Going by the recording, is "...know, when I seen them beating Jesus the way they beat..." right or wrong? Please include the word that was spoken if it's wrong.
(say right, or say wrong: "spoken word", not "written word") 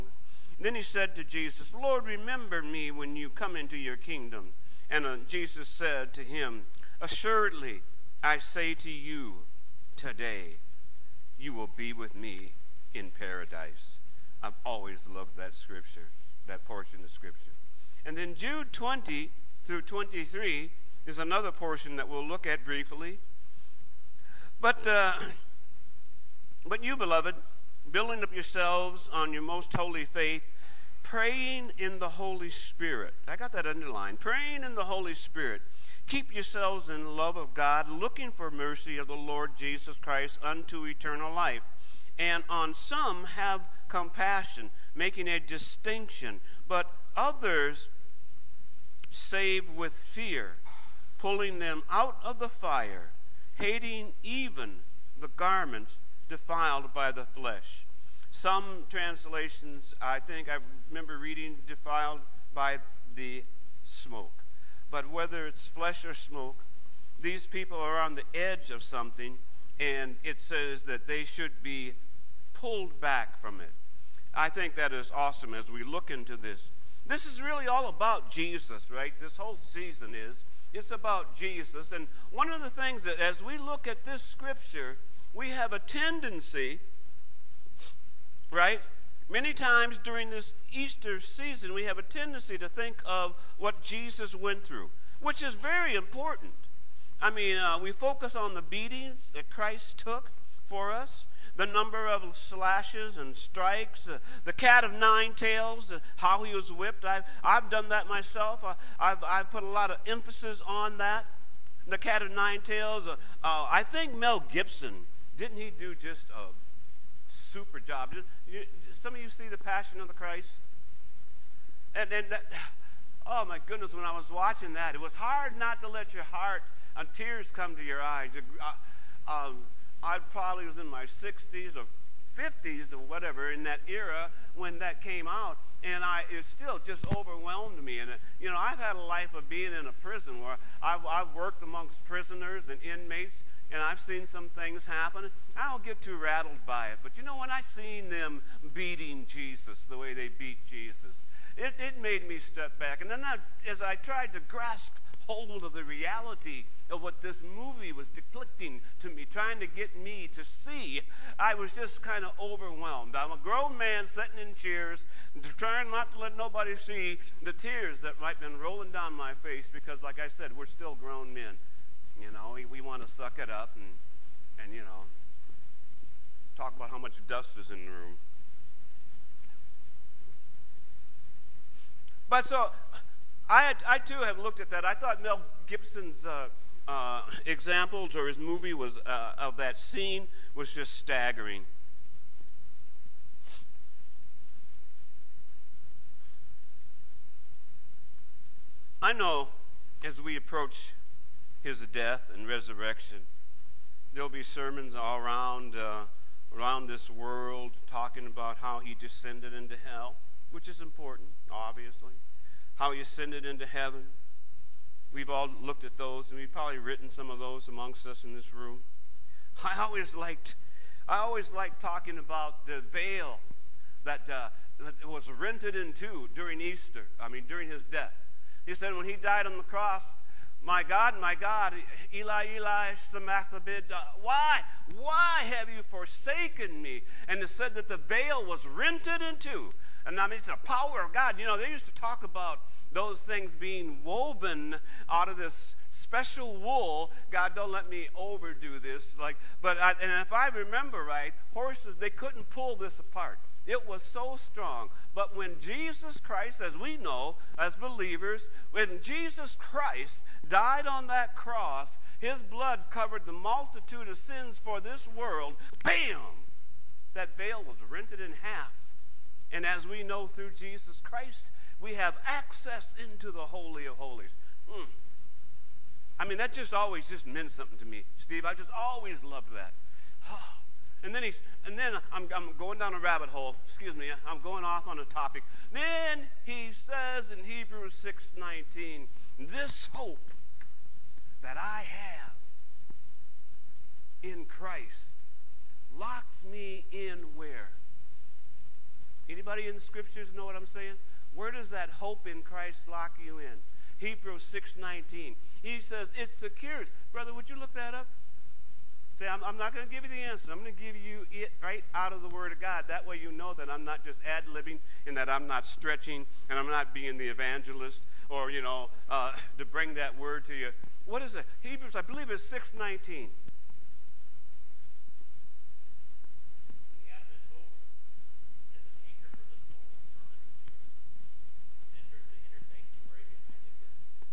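right.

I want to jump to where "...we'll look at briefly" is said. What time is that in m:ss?
0:22.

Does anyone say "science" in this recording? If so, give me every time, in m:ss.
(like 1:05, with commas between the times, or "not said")
not said.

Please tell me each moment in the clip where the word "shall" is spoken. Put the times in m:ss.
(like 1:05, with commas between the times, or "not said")
not said.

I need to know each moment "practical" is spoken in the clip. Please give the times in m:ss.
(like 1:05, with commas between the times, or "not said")
not said.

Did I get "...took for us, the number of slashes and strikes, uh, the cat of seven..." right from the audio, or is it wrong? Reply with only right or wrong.
wrong.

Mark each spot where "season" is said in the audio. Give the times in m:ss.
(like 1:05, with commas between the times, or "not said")
1:19, 1:31.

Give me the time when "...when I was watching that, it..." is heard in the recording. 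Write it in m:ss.
2:03.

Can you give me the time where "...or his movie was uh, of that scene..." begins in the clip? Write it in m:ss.
3:08.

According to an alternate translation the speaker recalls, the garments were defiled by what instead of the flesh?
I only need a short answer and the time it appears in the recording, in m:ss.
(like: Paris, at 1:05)
The smoke, at 1:03.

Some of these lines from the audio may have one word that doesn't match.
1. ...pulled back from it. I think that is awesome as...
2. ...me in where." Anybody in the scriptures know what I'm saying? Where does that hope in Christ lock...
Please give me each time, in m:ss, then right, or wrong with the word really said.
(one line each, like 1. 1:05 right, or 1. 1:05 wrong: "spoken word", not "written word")
1. 1:12 right
2. 4:56 right.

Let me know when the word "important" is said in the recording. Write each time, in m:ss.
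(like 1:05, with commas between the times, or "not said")
1:35, 3:30.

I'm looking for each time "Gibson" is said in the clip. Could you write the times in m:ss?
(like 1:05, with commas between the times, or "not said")
1:54, 3:05.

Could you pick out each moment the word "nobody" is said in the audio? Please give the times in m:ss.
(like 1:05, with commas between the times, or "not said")
2:46.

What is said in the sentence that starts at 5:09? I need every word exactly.
say, I'm, I'm not going to give you the answer.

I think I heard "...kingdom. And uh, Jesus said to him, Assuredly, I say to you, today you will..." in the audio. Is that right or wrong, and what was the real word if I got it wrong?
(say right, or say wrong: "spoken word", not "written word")
right.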